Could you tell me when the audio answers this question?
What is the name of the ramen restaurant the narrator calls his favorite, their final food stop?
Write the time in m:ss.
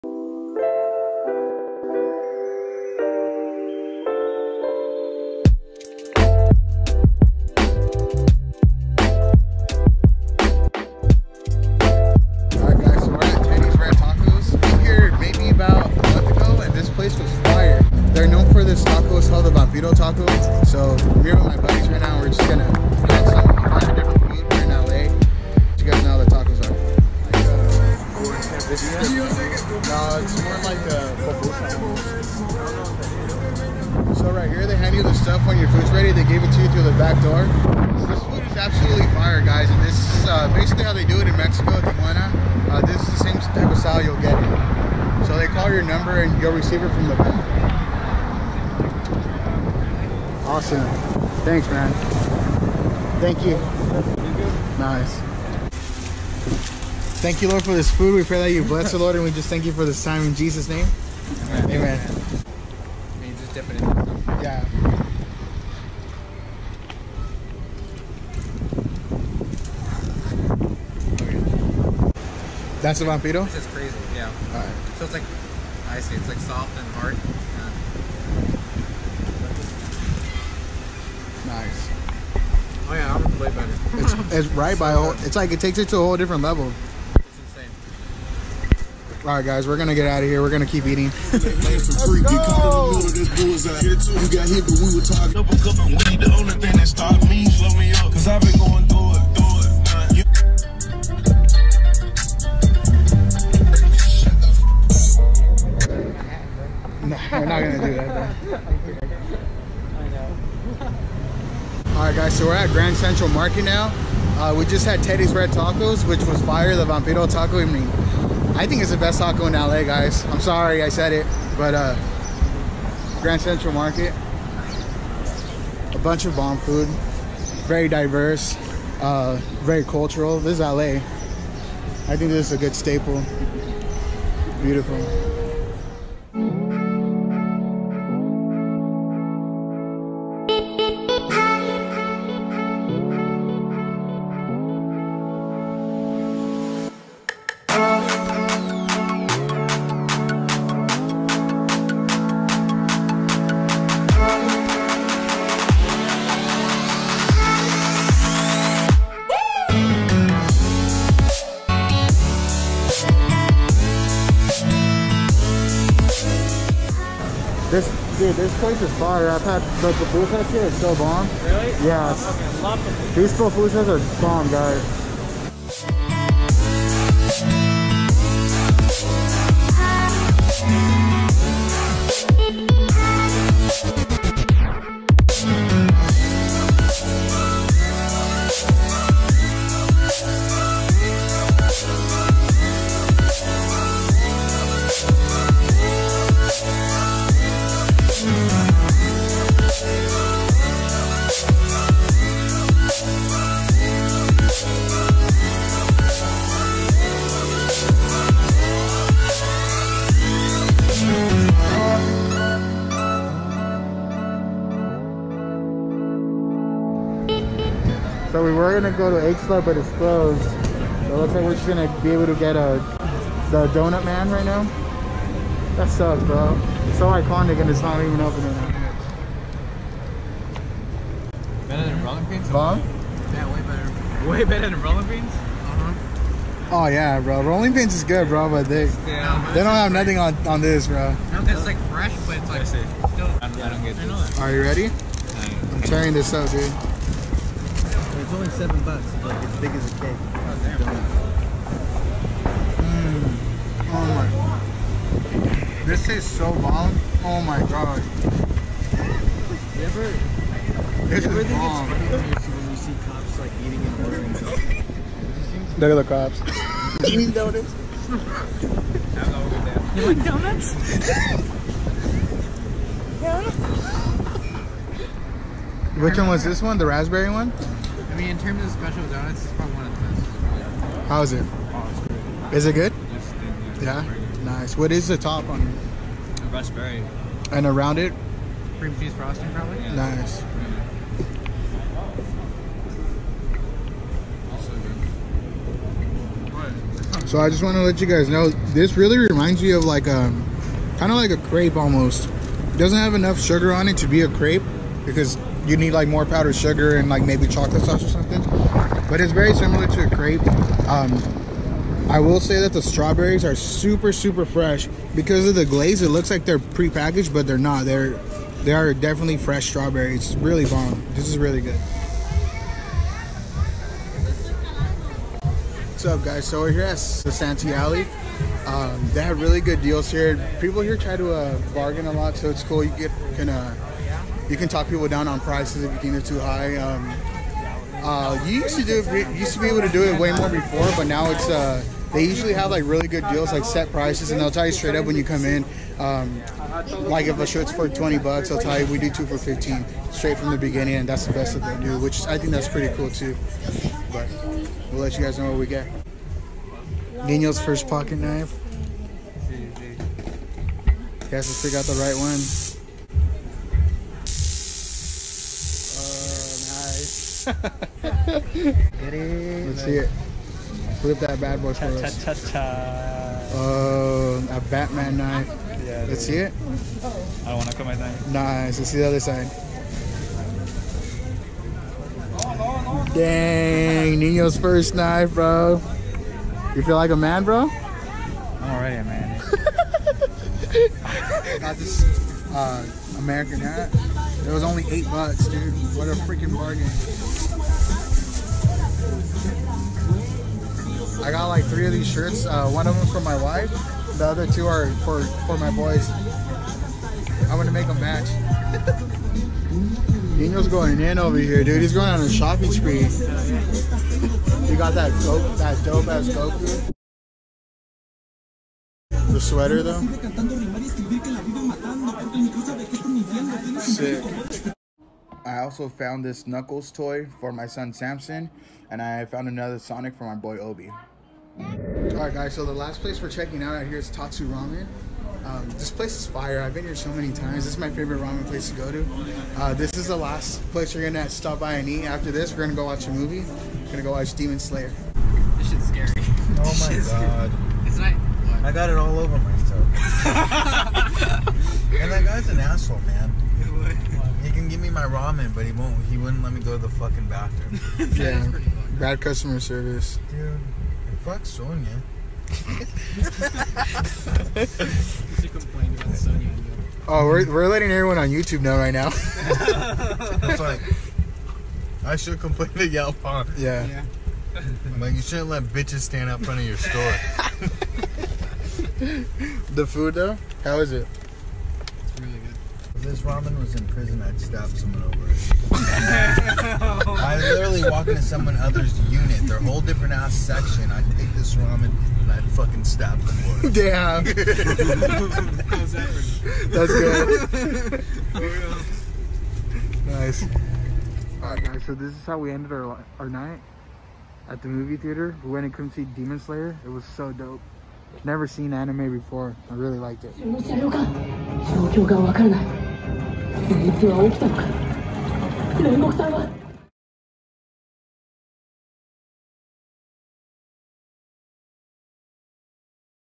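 7:14.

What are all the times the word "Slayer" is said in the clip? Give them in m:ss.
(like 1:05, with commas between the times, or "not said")
7:24, 8:26.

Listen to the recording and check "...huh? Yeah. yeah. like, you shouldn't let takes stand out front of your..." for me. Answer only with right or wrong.
wrong.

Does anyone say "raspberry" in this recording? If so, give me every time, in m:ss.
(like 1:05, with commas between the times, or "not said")
4:36, 4:46.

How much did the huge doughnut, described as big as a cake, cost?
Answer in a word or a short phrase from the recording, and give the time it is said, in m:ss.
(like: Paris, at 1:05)
$7, at 4:08.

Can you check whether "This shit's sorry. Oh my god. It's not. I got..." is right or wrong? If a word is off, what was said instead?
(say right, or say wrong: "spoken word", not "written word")
wrong: "scary", not "sorry".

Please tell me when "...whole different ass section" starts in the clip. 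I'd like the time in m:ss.
8:09.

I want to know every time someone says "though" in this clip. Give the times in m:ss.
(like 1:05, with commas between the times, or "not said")
6:59, 8:00.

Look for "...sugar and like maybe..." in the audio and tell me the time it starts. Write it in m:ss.
5:06.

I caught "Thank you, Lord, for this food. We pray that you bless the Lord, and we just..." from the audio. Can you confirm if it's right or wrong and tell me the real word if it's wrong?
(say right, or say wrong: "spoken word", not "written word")
right.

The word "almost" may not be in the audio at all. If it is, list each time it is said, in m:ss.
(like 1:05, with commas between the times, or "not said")
5:01.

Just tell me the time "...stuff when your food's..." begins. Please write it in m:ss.
0:35.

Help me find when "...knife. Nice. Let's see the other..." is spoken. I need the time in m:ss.
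6:17.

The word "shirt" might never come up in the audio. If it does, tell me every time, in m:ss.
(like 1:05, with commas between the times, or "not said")
5:47, 6:42.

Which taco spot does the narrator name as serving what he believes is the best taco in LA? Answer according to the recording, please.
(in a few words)
Teddy's Red Tacos.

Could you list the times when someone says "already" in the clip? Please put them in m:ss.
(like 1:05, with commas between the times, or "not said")
6:28.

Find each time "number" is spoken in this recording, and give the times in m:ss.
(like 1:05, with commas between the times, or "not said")
0:45.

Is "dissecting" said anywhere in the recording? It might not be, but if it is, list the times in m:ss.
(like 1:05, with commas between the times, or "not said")
not said.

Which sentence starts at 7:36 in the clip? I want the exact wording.
He wouldn't let me go to the fucking bathroom.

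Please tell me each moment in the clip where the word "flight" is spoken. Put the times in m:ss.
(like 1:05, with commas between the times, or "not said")
not said.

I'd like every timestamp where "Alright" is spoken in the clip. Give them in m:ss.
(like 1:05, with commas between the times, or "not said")
7:11, 8:21.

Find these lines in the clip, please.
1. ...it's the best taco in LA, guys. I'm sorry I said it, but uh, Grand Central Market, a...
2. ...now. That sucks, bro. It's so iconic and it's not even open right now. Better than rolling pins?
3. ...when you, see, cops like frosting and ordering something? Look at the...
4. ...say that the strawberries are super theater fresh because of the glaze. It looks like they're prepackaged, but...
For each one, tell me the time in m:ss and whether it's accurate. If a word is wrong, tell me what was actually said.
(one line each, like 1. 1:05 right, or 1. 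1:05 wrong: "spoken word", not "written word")
1. 1:58 right
2. 3:44 right
3. 4:22 wrong: "eating", not "frosting"
4. 5:12 wrong: "super", not "theater".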